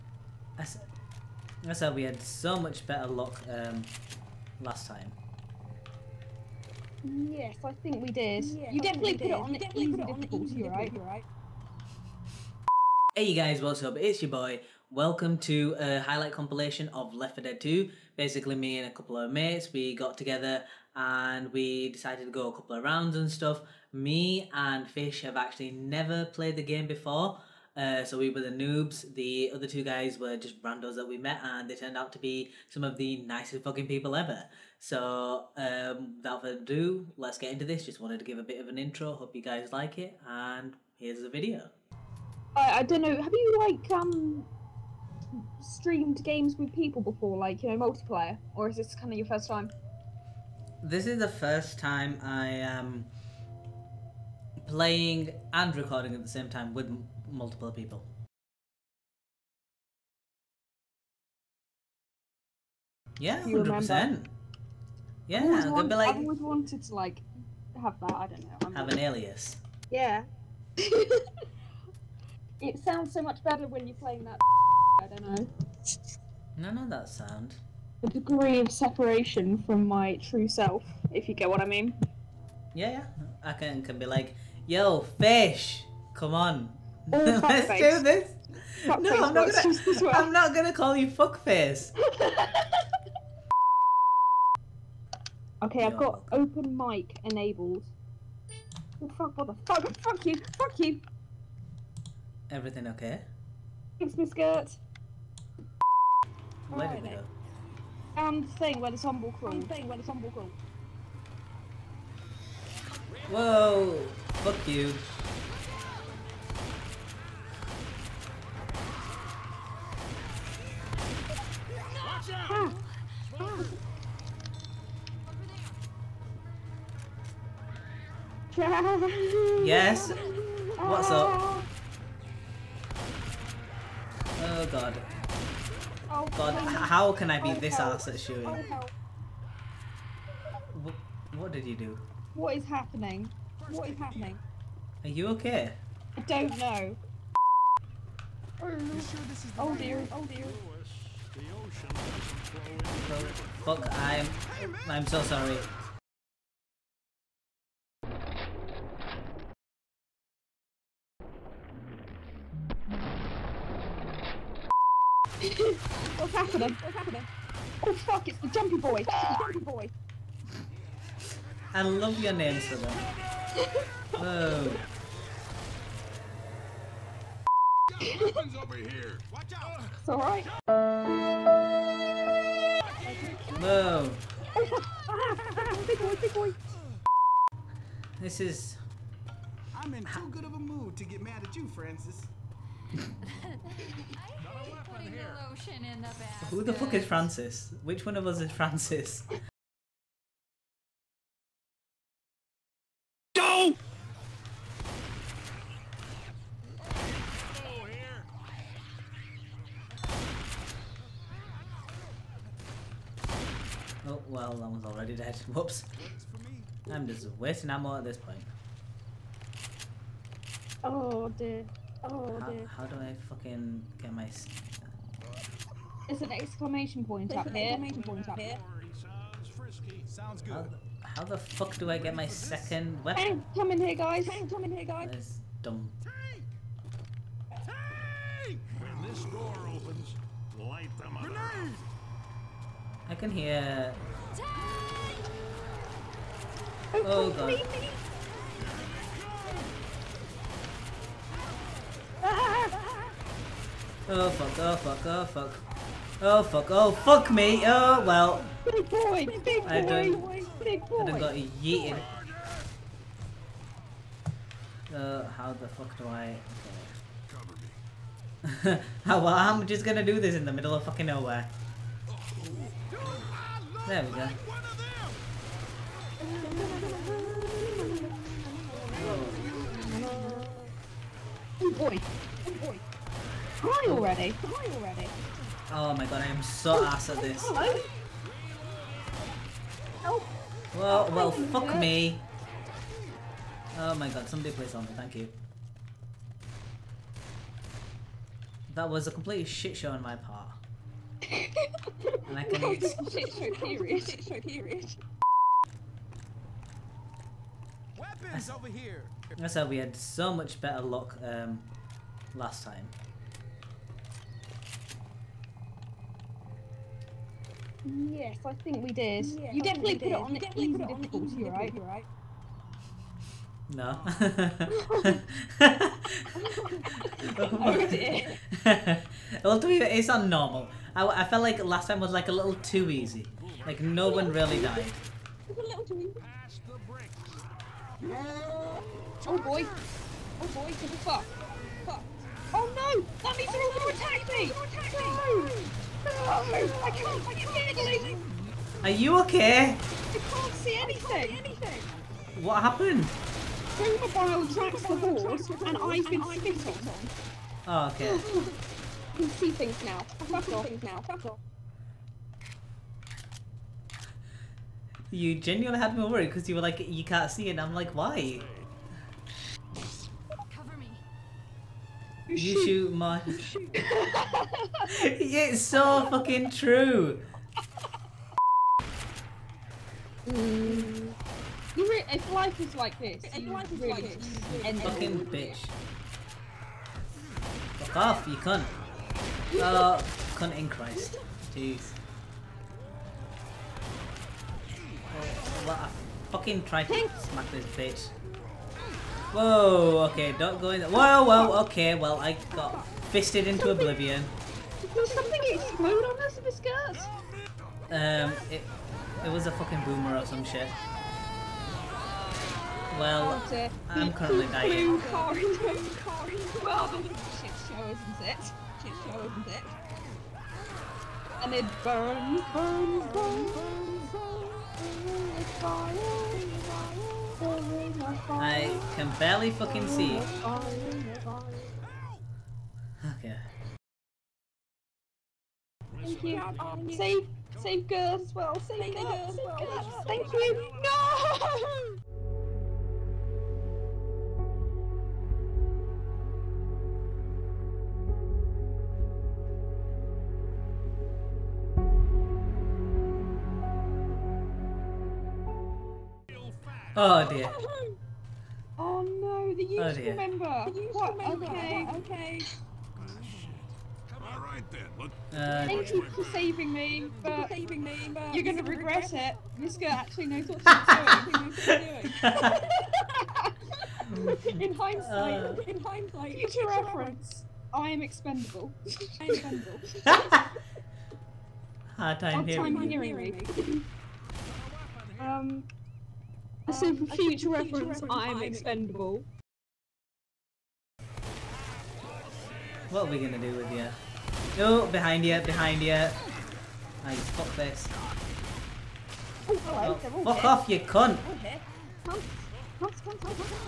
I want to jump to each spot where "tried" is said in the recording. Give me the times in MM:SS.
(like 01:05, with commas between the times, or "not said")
06:36.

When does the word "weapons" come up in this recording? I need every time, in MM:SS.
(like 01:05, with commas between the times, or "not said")
02:58, 03:53, 05:07.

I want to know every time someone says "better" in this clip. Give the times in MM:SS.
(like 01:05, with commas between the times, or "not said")
00:02, 01:13, 05:10.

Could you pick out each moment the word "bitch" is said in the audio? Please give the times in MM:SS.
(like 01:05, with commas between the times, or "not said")
06:25, 06:37.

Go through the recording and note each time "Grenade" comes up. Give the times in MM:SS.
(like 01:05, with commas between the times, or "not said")
04:01.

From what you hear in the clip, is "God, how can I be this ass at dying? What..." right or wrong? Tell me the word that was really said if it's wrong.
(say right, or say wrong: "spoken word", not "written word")
wrong: "shooting", not "dying".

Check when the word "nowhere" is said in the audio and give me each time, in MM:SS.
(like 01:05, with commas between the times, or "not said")
04:31.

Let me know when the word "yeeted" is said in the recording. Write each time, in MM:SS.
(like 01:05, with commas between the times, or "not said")
04:21.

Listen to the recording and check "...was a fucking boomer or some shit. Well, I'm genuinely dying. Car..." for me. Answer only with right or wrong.
wrong.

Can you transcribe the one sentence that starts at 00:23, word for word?
Me and Fish have actually never played the game before uh, so we were the noobs.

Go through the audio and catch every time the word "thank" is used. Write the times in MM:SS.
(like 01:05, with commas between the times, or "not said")
01:43, 04:54, 07:16, 07:20, 07:45.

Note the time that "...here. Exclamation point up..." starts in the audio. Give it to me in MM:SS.
03:47.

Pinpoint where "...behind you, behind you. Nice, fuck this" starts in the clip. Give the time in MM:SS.
08:14.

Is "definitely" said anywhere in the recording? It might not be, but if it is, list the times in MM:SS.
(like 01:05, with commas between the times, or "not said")
00:08, 05:19.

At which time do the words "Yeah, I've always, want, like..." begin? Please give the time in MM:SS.
01:05.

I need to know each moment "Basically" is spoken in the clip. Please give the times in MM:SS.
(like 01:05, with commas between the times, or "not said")
00:18.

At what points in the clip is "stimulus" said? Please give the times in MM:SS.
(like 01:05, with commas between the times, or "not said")
not said.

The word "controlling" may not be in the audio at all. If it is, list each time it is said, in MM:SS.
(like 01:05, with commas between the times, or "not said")
not said.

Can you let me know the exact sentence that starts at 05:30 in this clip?
I, I felt like last time was like a little too easy.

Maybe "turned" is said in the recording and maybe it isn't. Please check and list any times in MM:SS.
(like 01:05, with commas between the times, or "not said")
00:31.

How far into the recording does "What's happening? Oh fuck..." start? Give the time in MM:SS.
02:46.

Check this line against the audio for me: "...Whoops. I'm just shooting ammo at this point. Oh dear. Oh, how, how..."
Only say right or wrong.
wrong.